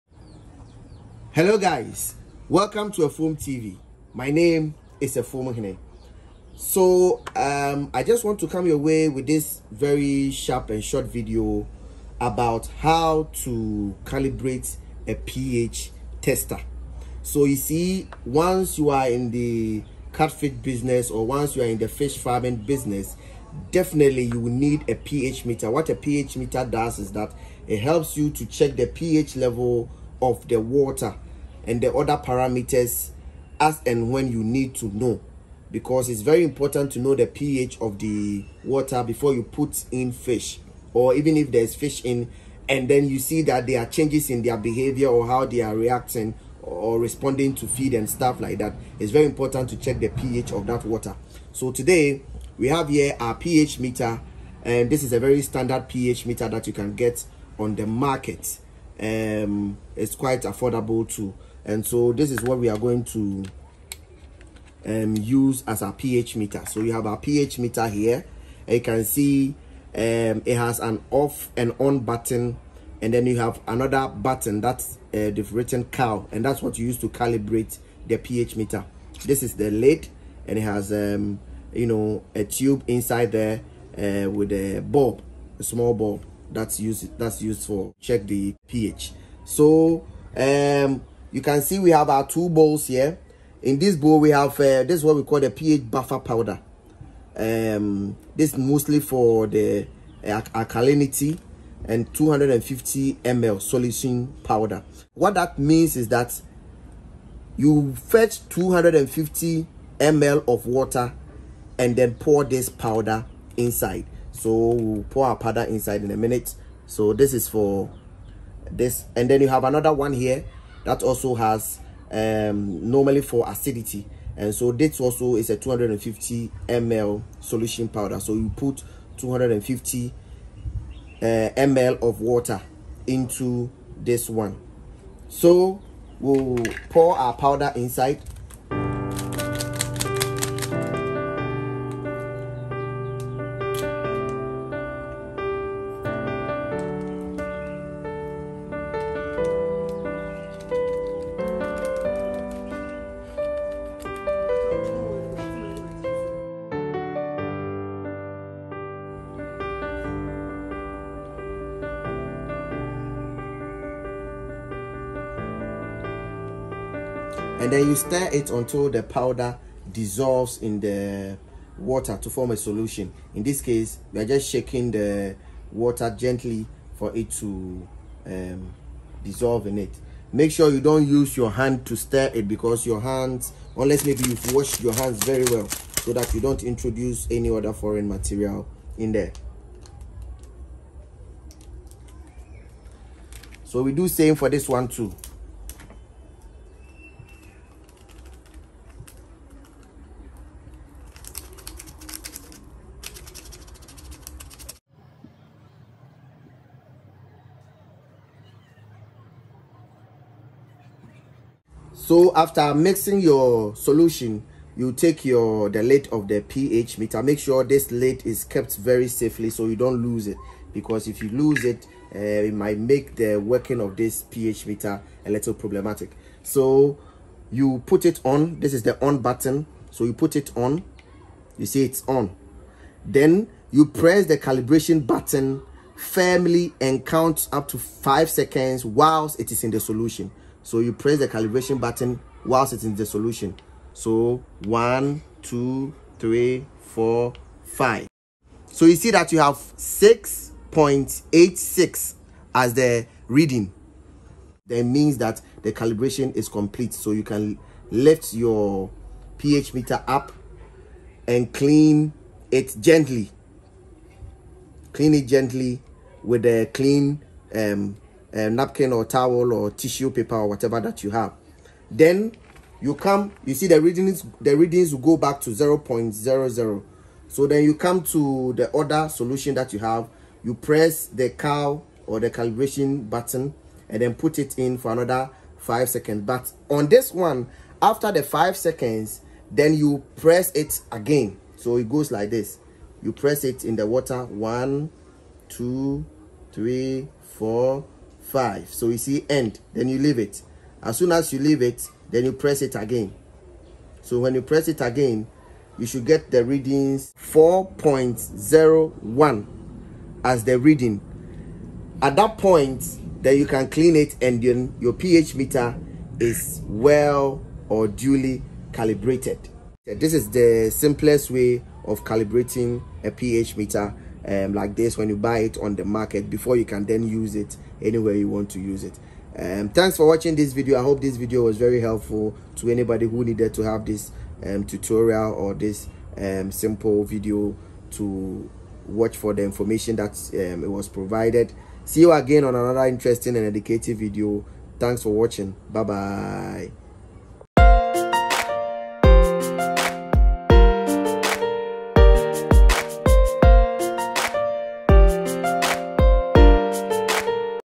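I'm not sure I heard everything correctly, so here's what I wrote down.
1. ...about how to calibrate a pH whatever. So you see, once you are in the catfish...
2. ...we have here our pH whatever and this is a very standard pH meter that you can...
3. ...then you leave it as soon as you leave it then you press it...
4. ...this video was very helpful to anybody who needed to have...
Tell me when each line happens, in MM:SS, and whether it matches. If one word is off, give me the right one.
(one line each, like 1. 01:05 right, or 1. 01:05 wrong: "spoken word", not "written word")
1. 00:12 wrong: "tester", not "whatever"
2. 00:52 wrong: "meter", not "whatever"
3. 04:59 right
4. 05:31 right.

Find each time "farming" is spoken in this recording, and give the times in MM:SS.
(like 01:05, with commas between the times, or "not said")
00:22.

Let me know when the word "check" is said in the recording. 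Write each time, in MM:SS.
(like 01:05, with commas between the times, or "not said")
00:28, 00:49, 01:27.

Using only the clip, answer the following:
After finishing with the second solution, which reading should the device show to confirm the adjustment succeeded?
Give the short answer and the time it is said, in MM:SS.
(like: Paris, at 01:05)
4.01, at 05:07.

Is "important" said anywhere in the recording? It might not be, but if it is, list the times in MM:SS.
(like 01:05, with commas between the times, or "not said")
00:36, 00:49.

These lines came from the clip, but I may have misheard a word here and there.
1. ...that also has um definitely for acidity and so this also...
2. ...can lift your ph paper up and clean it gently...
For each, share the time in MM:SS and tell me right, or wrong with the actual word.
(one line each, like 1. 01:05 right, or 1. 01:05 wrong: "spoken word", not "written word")
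1. 02:00 wrong: "normally", not "definitely"
2. 04:17 wrong: "meter", not "paper".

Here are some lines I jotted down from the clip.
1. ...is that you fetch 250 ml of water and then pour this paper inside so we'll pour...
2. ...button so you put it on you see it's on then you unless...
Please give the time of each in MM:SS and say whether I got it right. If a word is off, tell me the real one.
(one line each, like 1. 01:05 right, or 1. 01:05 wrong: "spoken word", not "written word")
1. 01:45 wrong: "powder", not "paper"
2. 03:49 wrong: "press", not "unless".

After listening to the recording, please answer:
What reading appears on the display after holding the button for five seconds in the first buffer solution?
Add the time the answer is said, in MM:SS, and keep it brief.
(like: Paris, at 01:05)
6.86, at 04:09.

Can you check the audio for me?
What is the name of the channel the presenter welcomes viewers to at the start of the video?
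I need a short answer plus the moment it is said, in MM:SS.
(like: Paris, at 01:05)
Afuom TV, at 00:03.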